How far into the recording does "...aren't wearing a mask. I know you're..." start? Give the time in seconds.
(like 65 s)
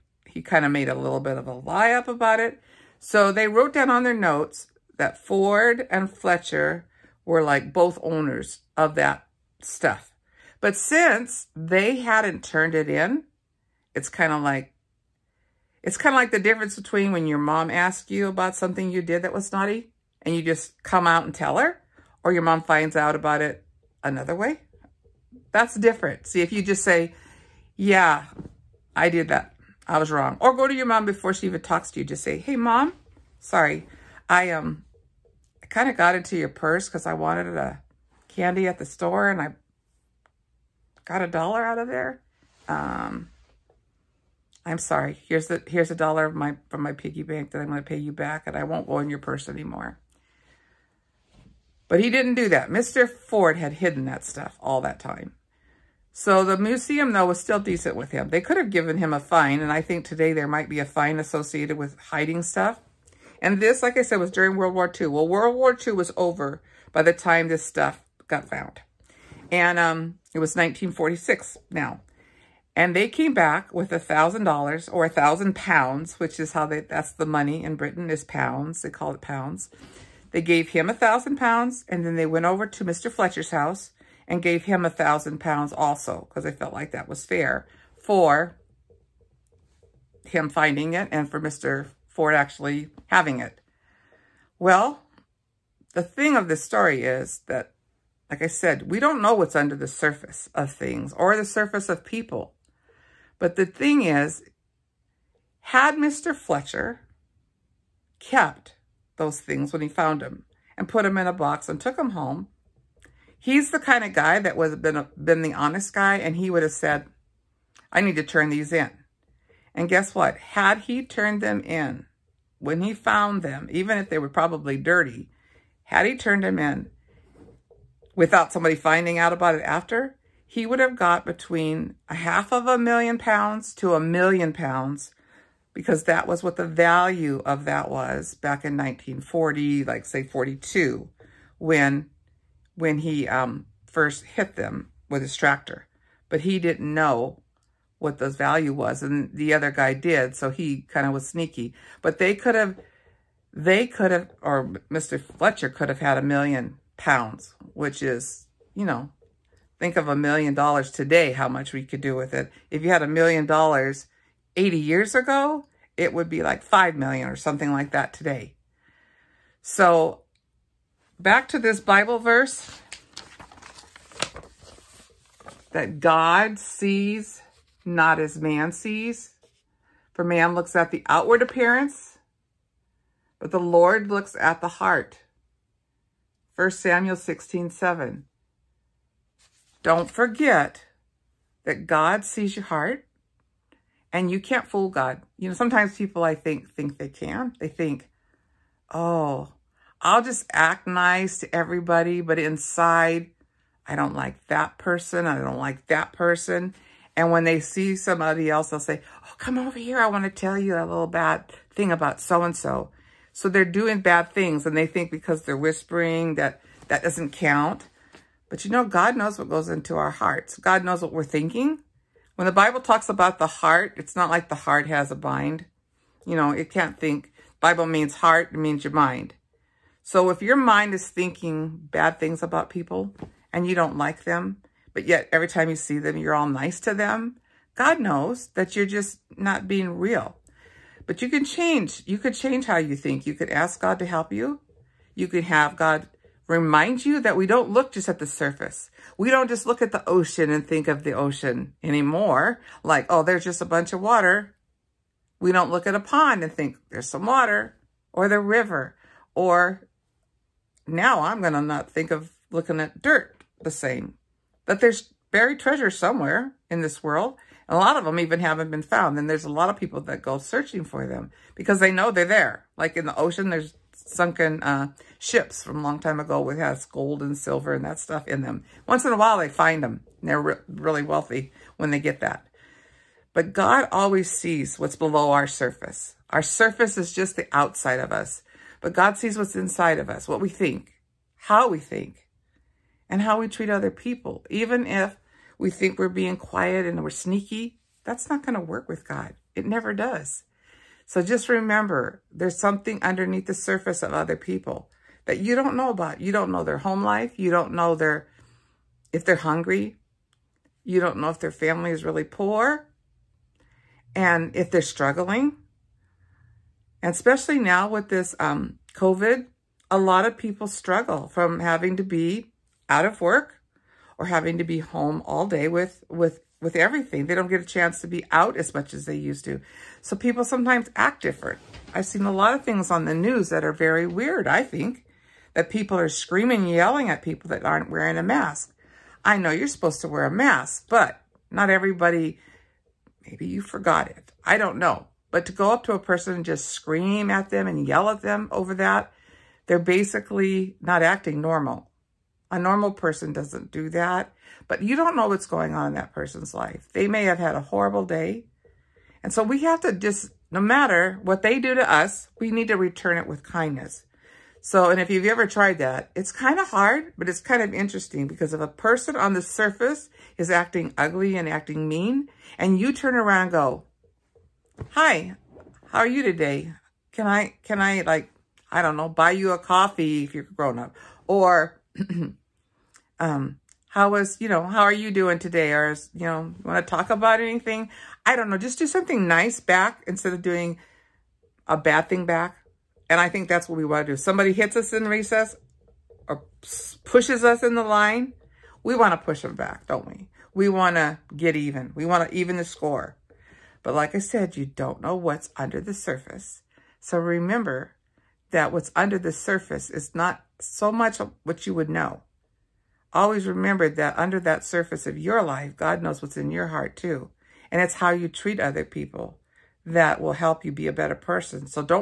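337 s.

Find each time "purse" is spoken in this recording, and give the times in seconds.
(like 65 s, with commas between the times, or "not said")
36 s, 49 s.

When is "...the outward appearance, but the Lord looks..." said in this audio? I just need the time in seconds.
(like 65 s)
180 s.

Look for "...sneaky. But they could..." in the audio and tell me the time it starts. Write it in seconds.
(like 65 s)
151 s.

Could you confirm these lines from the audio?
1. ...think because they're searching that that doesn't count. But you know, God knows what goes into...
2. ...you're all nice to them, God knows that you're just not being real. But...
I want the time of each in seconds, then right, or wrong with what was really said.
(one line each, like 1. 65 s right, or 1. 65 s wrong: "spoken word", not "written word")
1. 214 s wrong: "whispering", not "searching"
2. 236 s right.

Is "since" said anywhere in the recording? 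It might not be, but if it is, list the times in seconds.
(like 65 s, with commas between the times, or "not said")
10 s.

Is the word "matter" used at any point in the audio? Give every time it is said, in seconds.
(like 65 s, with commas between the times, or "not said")
360 s.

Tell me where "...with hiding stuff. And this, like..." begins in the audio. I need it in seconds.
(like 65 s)
61 s.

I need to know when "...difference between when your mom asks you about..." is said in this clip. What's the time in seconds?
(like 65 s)
16 s.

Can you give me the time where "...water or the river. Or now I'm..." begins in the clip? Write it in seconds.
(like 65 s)
257 s.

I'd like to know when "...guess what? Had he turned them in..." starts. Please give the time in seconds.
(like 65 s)
119 s.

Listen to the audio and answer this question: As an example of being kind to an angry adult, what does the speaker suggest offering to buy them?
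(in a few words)
a coffee.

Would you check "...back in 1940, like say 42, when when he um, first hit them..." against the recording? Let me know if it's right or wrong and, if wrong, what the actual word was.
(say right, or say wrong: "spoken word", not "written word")
right.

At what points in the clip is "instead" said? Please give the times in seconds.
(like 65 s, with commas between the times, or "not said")
390 s.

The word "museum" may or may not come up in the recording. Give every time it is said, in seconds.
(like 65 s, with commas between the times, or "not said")
56 s.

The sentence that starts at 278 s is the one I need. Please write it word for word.
Once in a while, they find them.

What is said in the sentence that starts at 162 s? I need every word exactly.
If you had a million dollars 80 years ago, it would be like 5 million or something like that today.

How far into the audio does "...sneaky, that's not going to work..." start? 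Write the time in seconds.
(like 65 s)
297 s.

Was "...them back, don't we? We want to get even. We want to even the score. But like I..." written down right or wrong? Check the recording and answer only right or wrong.
right.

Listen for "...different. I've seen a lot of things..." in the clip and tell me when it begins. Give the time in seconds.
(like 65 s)
331 s.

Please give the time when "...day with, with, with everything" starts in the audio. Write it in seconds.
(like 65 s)
325 s.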